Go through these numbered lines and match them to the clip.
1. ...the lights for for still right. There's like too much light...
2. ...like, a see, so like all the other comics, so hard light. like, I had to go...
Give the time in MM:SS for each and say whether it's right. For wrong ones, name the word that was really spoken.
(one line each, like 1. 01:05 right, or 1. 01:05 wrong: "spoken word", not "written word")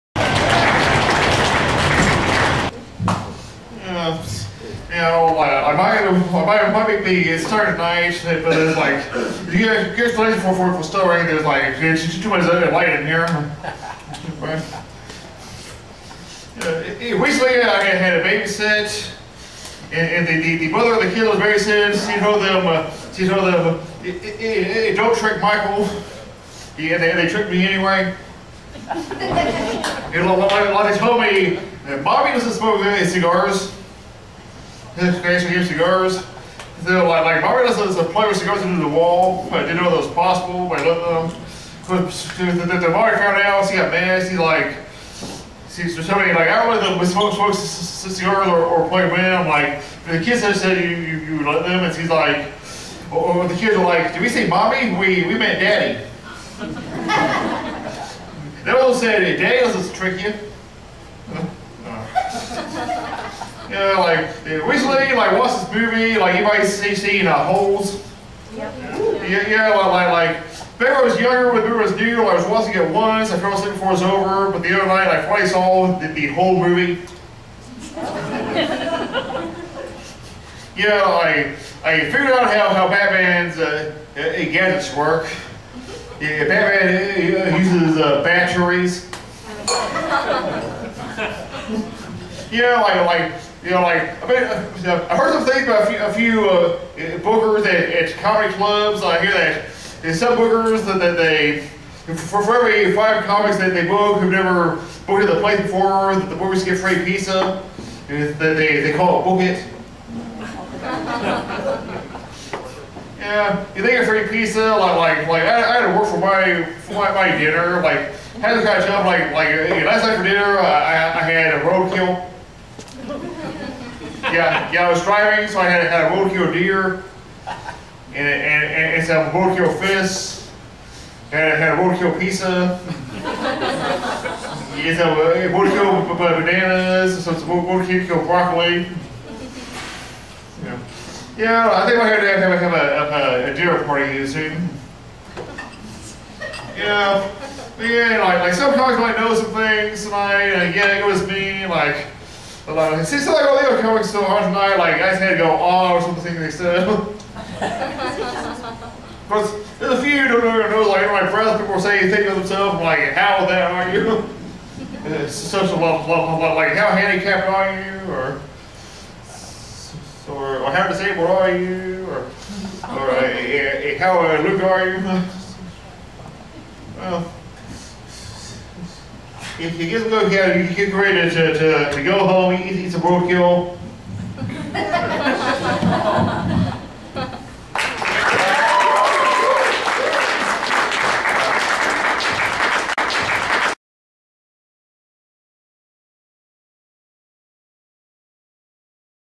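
1. 00:10 right
2. 02:31 wrong: "tonight", not "light".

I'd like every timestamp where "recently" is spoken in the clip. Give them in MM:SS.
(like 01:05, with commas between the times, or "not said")
00:17, 01:04.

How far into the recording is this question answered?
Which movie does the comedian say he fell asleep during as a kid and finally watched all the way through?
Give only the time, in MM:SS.
01:07.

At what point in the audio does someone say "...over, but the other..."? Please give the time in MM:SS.
01:14.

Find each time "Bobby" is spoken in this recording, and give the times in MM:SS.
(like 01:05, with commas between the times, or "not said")
00:32, 00:37, 00:42.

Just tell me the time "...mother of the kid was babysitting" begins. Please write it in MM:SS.
00:20.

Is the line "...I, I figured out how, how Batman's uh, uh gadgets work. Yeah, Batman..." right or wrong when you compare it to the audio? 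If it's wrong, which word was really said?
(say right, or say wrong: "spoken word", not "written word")
right.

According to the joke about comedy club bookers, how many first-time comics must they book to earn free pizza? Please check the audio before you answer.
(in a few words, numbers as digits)
5.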